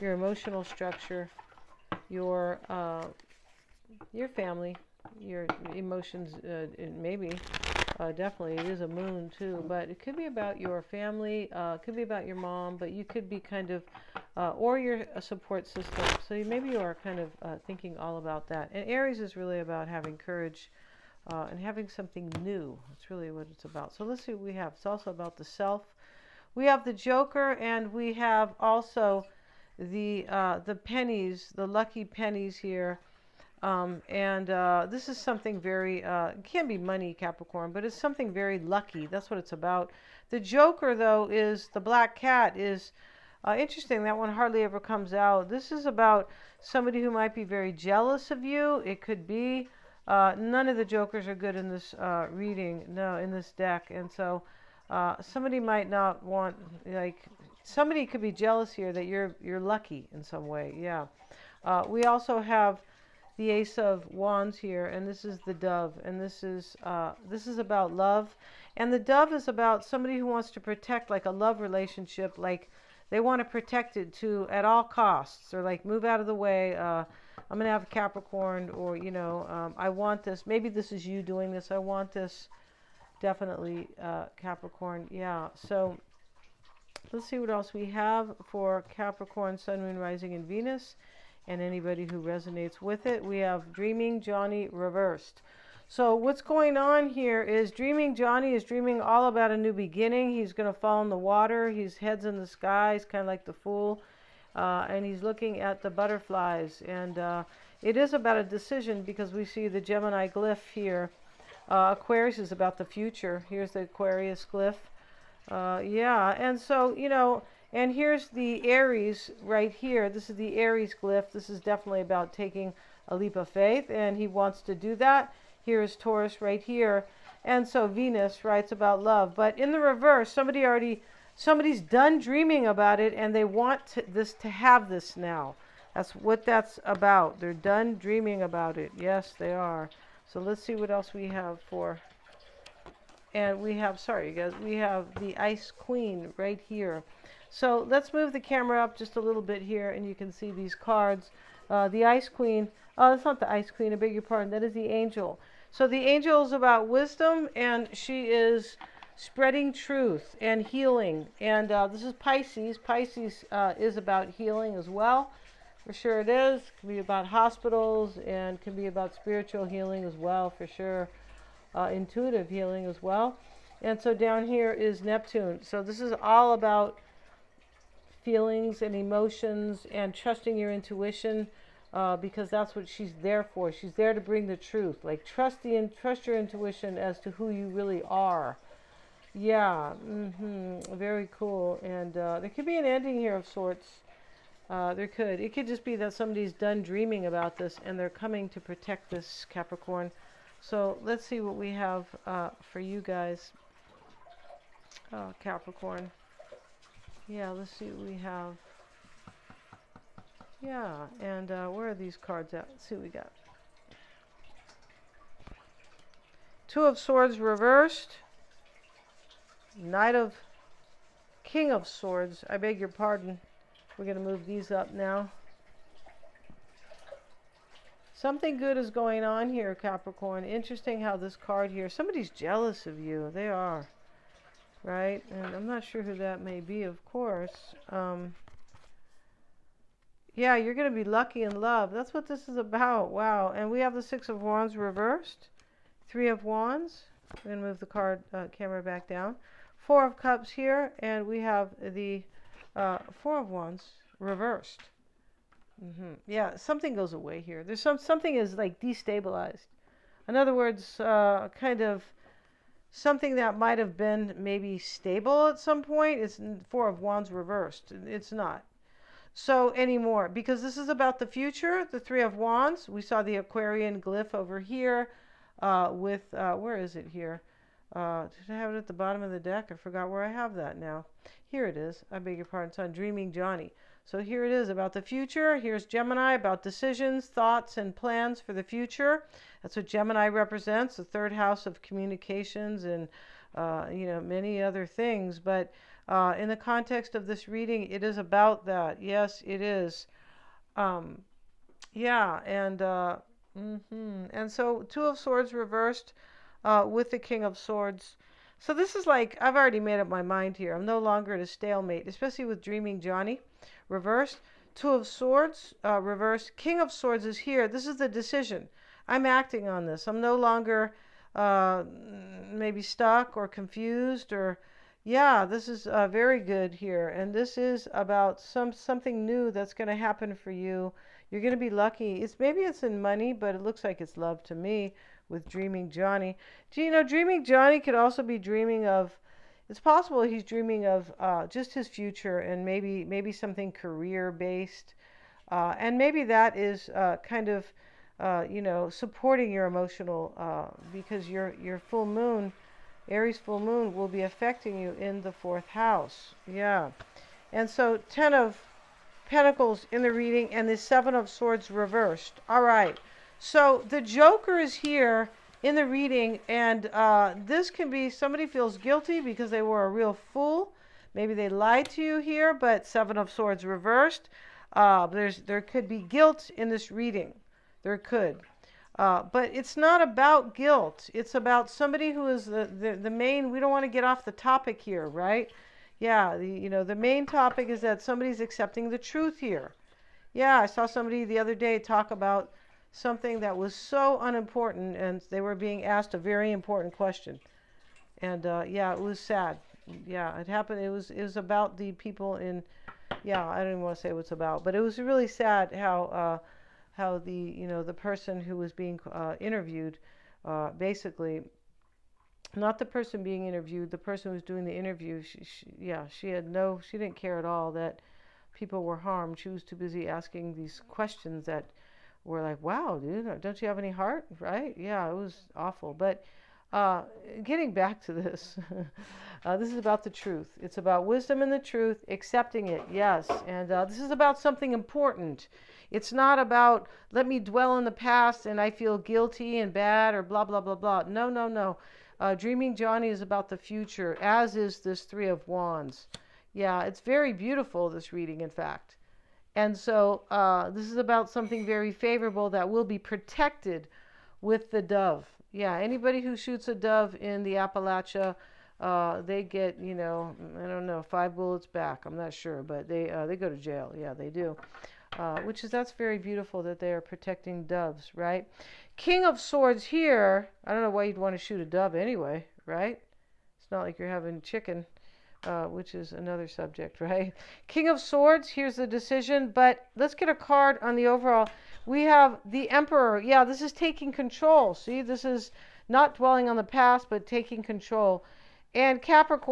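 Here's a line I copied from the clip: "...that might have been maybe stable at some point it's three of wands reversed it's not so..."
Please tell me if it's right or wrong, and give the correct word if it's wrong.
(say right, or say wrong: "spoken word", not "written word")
wrong: "four", not "three".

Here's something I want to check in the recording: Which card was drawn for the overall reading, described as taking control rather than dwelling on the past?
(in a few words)
the Emperor.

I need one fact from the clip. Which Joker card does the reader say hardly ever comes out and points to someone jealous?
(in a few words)
the black cat.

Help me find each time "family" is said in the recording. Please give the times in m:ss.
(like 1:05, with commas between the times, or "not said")
0:04, 0:10.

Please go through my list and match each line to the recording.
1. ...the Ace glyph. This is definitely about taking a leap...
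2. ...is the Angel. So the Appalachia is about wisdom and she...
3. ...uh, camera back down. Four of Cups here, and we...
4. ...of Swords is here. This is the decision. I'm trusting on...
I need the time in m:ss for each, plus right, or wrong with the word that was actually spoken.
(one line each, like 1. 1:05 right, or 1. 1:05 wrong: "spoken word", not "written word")
1. 2:00 wrong: "Aries", not "Ace"
2. 2:34 wrong: "Angel", not "Appalachia"
3. 4:08 right
4. 5:16 wrong: "acting", not "trusting".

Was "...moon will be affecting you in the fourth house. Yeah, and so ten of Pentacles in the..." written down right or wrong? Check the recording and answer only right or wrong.
right.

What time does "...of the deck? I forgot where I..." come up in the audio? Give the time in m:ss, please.
4:39.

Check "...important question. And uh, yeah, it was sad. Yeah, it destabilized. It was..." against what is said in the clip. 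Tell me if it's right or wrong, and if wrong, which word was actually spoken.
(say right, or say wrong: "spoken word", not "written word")
wrong: "happened", not "destabilized".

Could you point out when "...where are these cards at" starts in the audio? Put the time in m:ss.
3:31.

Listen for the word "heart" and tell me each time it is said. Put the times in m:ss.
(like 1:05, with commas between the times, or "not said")
7:03.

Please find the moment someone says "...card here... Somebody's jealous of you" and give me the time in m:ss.
3:51.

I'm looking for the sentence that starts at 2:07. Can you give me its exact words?
And so Venus writes about love.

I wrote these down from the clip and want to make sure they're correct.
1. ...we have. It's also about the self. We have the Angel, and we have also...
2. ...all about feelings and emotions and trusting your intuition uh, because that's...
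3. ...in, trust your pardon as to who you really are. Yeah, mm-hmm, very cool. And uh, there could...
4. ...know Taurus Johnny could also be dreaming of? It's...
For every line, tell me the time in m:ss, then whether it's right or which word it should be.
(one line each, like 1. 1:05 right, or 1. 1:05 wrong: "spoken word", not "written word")
1. 0:24 wrong: "Joker", not "Angel"
2. 2:56 right
3. 3:05 wrong: "intuition", not "pardon"
4. 5:36 wrong: "Dreaming", not "Taurus".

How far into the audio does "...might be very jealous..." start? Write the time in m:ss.
0:47.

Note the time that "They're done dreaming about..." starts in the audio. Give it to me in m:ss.
2:17.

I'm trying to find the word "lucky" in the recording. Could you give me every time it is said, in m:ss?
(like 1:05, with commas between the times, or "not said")
0:31, 0:38, 0:59, 4:01, 5:31.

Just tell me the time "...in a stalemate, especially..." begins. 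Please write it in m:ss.
5:11.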